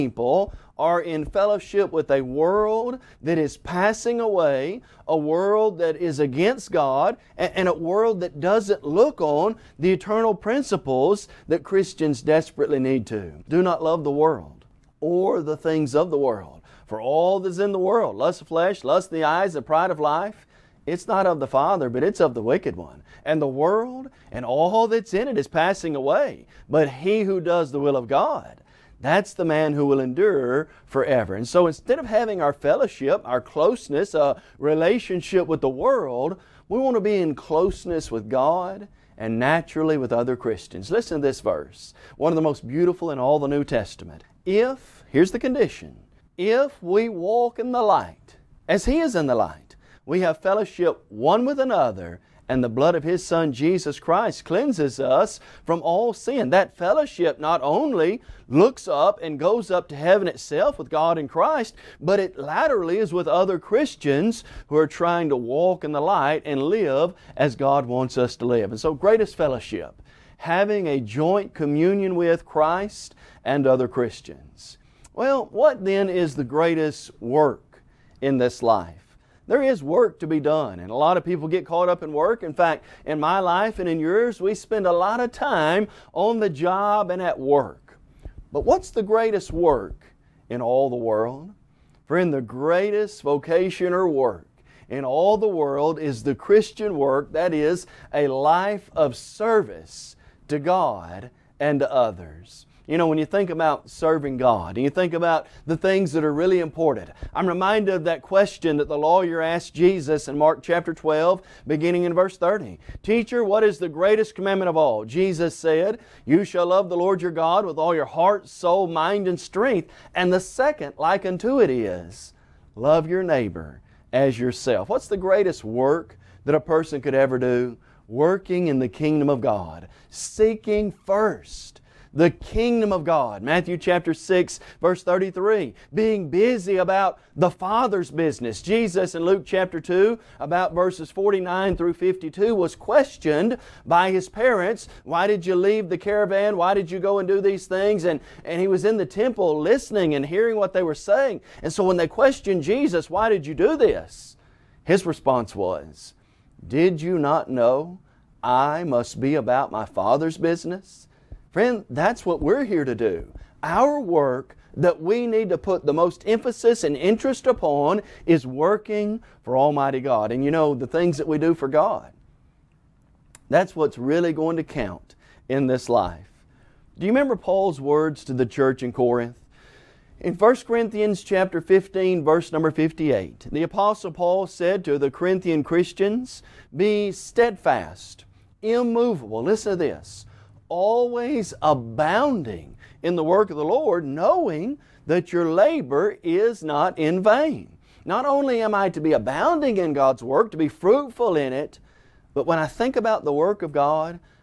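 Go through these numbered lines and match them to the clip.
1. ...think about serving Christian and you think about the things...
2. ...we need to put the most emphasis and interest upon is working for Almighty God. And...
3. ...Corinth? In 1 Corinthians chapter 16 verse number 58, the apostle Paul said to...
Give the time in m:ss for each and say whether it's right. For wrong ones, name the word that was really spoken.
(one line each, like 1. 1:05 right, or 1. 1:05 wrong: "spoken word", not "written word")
1. 1:43 wrong: "God", not "Christian"
2. 2:45 right
3. 2:58 wrong: "15", not "16".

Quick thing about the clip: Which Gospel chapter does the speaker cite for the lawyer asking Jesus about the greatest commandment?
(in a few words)
Mark 12.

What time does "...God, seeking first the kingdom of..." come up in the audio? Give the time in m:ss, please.
2:09.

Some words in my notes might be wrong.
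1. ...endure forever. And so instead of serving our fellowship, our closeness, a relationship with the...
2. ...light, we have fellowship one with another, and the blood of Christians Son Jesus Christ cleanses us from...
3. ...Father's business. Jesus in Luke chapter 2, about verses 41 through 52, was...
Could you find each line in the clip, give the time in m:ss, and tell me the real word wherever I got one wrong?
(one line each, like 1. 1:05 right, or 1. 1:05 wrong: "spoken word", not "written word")
1. 0:30 wrong: "having", not "serving"
2. 0:49 wrong: "His", not "Christians"
3. 2:17 wrong: "49", not "41".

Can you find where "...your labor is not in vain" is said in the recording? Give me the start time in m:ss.
3:15.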